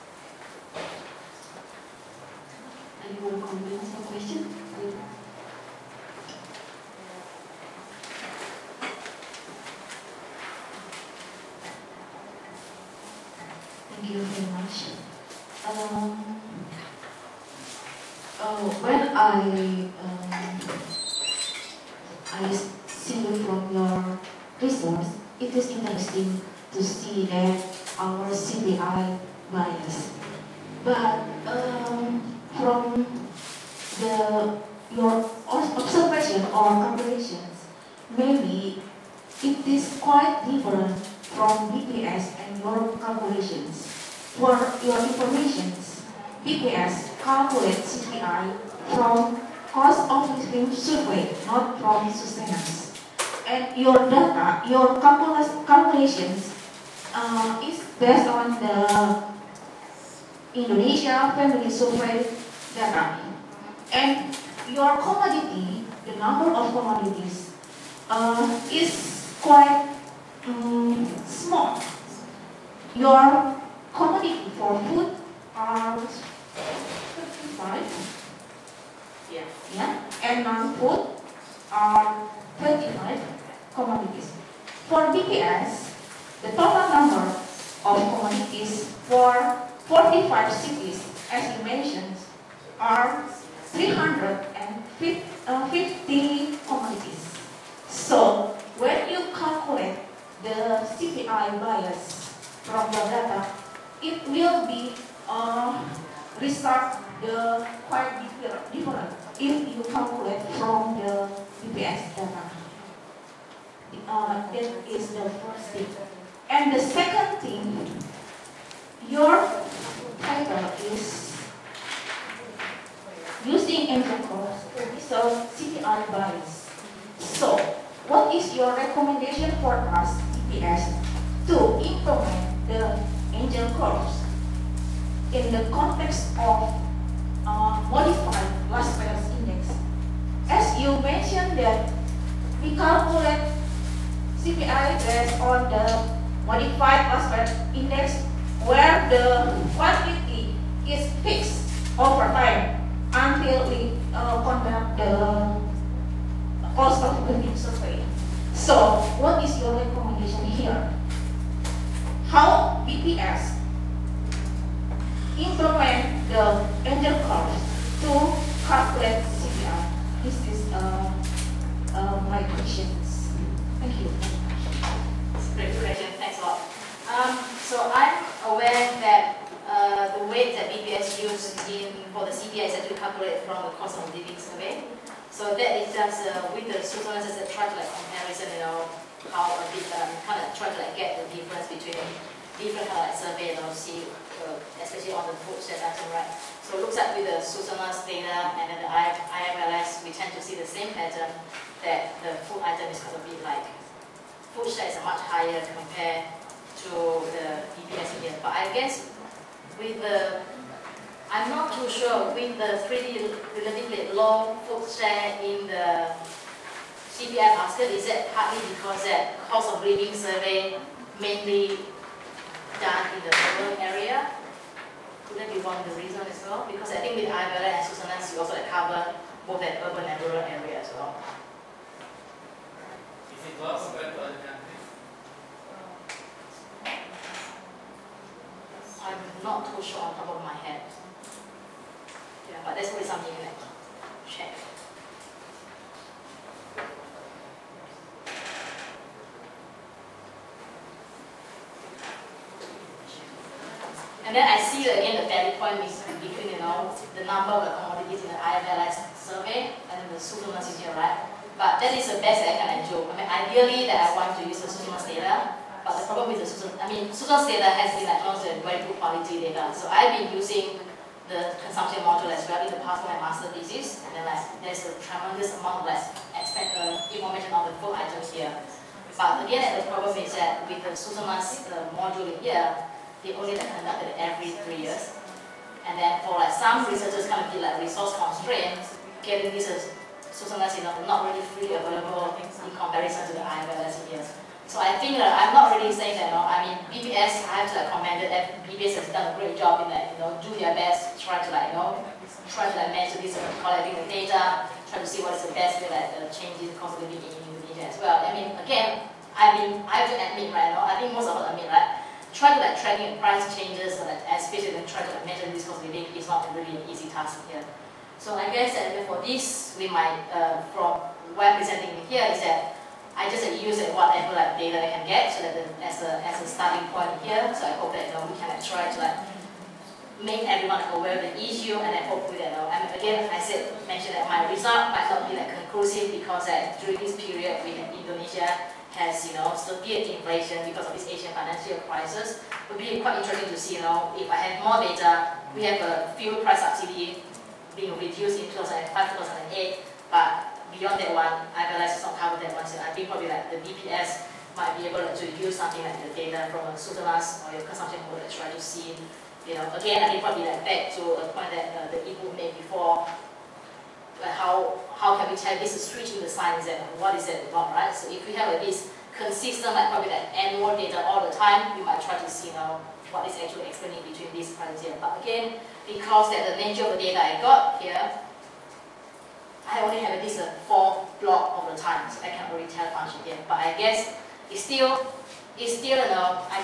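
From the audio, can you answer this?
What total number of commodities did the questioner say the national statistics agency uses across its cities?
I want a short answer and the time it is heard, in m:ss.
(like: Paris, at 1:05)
350, at 1:33.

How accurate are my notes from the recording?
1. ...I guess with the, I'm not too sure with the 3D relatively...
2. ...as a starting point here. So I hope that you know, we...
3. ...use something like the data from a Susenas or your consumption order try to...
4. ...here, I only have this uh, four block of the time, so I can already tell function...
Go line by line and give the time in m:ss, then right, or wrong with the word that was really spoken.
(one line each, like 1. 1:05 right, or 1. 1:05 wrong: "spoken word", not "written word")
1. 3:28 right
2. 5:26 right
3. 5:55 right
4. 6:17 right.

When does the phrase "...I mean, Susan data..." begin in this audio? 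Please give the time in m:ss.
4:26.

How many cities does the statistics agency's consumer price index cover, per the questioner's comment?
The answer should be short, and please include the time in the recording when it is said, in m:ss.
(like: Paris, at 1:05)
45, at 1:29.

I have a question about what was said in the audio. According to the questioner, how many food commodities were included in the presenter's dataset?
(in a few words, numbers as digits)
35.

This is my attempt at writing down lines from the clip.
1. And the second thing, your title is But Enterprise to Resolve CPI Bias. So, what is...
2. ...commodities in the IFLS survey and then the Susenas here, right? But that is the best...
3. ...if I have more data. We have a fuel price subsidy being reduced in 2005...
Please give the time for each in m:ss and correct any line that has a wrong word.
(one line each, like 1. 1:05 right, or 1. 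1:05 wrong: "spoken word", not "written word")
1. 1:56 wrong: "Using", not "But"
2. 4:17 right
3. 5:44 right.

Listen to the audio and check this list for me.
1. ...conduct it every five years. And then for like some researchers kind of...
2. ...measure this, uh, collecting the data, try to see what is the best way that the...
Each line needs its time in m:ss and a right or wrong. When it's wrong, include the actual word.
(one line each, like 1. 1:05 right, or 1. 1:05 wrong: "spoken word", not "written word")
1. 4:43 wrong: "three", not "five"
2. 5:02 right.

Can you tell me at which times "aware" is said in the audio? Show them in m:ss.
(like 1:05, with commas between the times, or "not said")
2:58, 5:30.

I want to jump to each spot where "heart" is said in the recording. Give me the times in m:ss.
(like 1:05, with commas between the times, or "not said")
not said.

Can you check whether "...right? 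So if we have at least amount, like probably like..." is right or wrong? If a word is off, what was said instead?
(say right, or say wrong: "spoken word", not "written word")
wrong: "consistent", not "amount".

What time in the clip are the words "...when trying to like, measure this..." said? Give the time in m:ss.
5:14.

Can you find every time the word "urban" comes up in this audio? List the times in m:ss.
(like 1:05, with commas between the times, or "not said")
3:43, 3:49.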